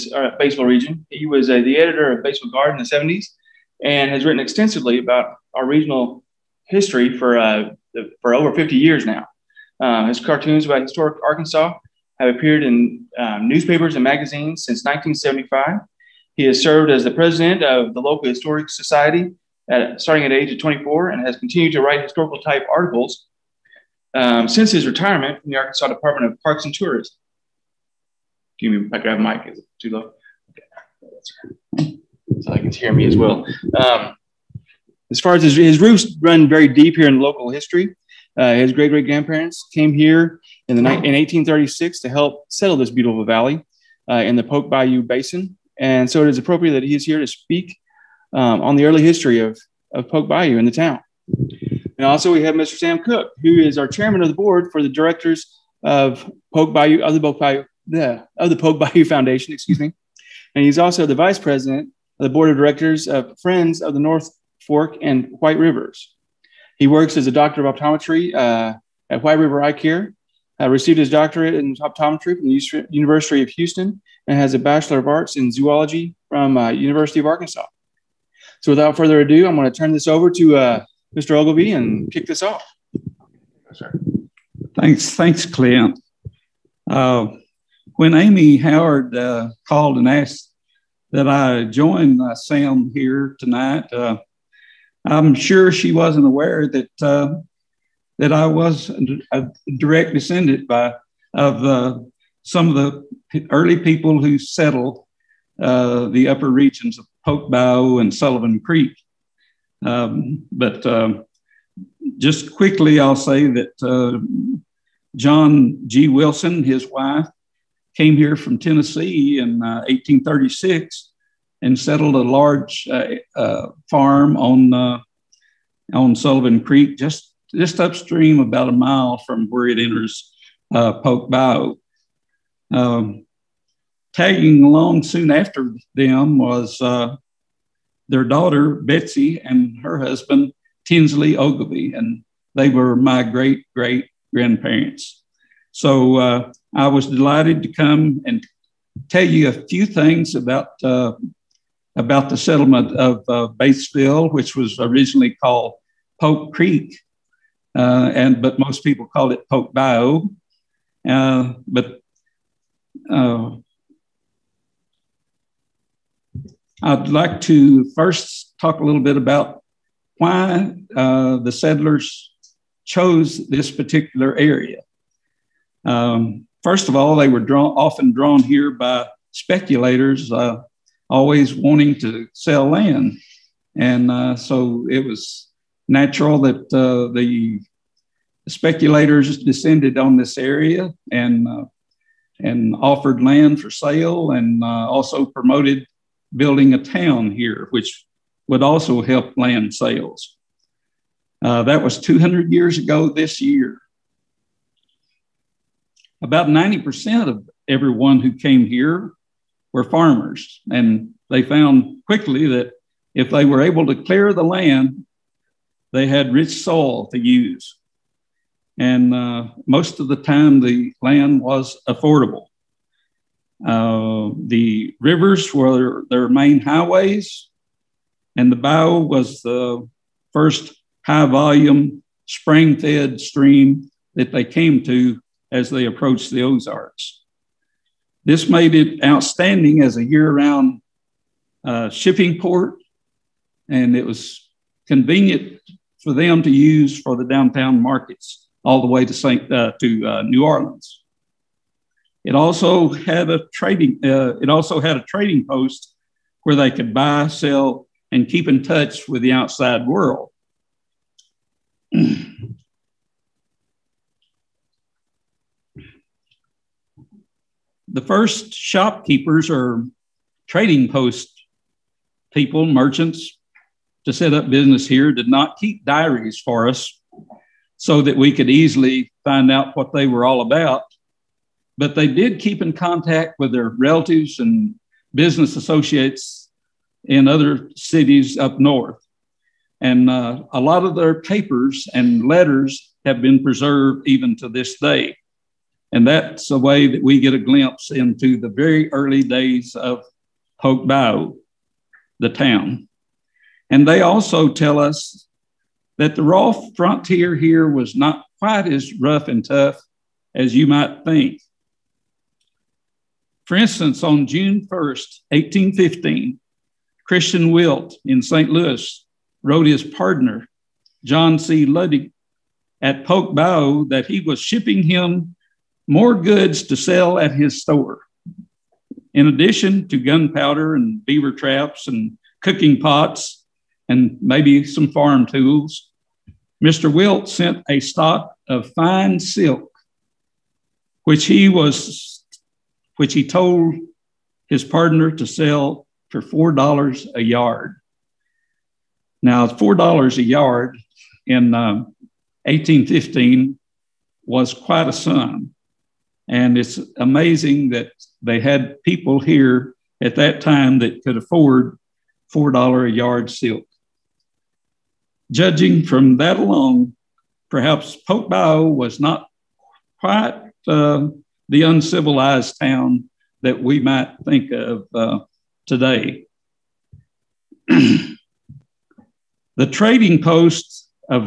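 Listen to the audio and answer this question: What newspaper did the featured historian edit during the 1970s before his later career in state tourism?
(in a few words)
Batesville Guard.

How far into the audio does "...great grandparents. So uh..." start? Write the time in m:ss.
2:23.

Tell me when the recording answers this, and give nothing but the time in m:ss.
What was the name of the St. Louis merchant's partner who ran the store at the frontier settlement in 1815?
5:21.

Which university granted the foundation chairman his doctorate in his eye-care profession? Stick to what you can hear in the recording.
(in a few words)
University of Houston.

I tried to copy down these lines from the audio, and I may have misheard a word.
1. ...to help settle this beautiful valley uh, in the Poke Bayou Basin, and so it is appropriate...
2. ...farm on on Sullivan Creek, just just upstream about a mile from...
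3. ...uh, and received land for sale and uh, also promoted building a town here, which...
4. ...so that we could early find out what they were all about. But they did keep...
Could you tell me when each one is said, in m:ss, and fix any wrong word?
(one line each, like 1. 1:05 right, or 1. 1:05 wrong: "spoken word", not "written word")
1. 0:42 right
2. 2:03 right
3. 3:11 wrong: "offered", not "received"
4. 4:37 wrong: "easily", not "early".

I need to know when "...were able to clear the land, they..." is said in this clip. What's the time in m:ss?
3:33.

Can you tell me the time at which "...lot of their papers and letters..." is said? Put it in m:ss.
4:50.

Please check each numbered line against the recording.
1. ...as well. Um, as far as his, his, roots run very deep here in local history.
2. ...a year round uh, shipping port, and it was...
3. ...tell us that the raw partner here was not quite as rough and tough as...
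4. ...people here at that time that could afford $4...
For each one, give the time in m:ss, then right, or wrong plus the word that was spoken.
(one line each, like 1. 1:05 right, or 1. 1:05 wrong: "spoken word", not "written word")
1. 0:33 right
2. 3:59 right
3. 5:04 wrong: "frontier", not "partner"
4. 5:58 right.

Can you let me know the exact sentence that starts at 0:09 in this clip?
Uh, his cartoons about historic Arkansas have appeared in um, newspapers and magazines since 1975.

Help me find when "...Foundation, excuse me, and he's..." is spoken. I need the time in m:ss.
0:59.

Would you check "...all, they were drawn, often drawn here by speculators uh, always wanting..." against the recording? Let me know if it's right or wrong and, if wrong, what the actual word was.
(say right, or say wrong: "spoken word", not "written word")
right.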